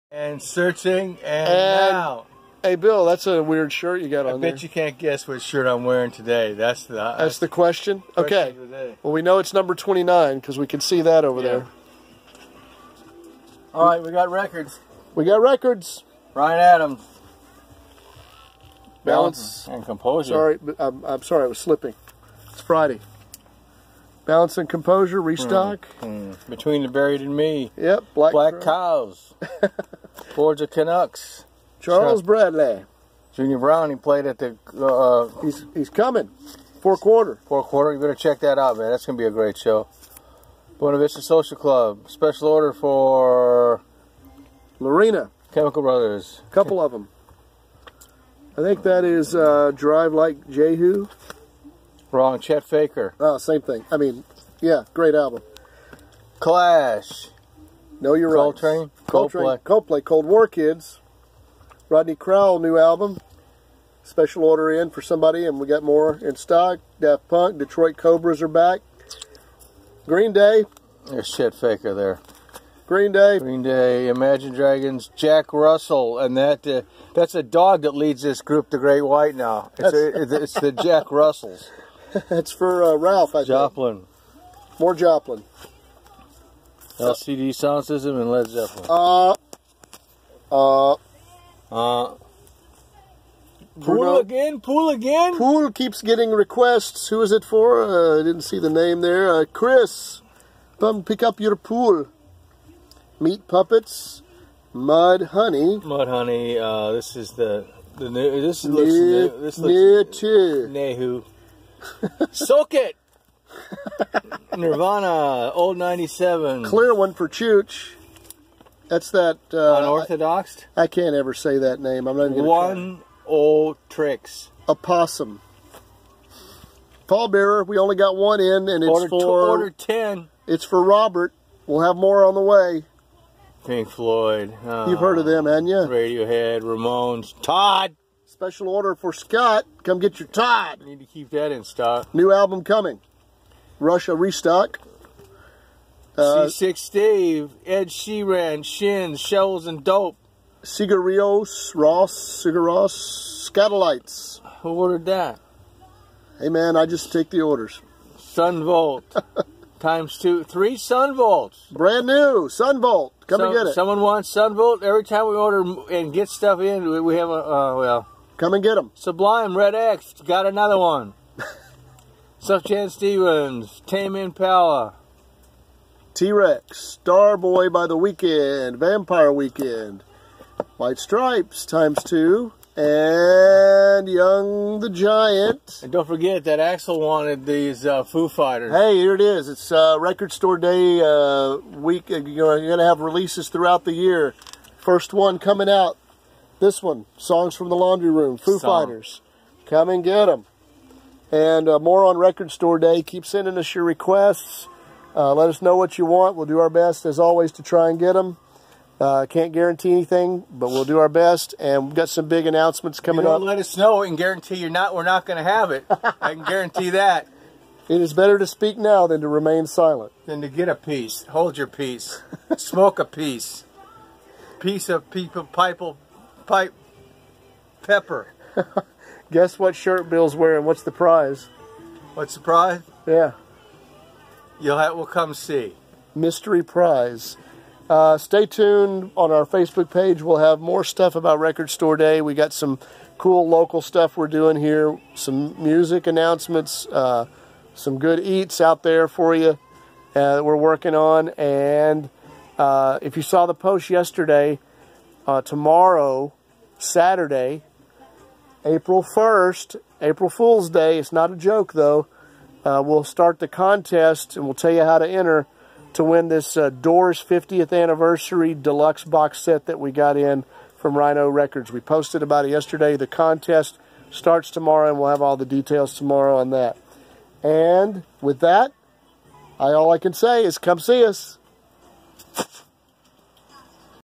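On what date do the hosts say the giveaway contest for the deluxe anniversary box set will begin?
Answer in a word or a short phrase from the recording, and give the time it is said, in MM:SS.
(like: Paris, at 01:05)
April 1st, at 04:18.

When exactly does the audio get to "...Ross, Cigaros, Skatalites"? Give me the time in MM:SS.
02:31.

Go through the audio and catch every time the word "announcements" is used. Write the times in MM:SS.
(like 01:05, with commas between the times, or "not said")
03:32, 04:06.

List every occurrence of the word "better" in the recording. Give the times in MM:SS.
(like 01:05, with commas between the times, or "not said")
00:37, 03:38.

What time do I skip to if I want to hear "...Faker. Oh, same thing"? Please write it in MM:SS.
00:52.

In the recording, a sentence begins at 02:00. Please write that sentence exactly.
I, I, can't ever say that name.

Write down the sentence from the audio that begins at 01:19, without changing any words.
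Now it's, a, it's the Jack Russells.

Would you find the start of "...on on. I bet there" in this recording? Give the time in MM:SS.
00:04.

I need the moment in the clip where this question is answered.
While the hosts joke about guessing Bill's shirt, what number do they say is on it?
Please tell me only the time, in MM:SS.
00:09.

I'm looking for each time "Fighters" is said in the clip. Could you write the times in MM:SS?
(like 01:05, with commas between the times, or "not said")
03:08, 03:18.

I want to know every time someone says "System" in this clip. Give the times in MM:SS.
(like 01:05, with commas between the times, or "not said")
01:27.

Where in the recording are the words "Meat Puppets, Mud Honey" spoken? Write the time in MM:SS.
01:43.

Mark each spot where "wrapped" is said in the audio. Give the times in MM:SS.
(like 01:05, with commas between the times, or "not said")
not said.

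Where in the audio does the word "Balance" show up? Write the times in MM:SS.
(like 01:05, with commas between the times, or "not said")
00:19, 00:24.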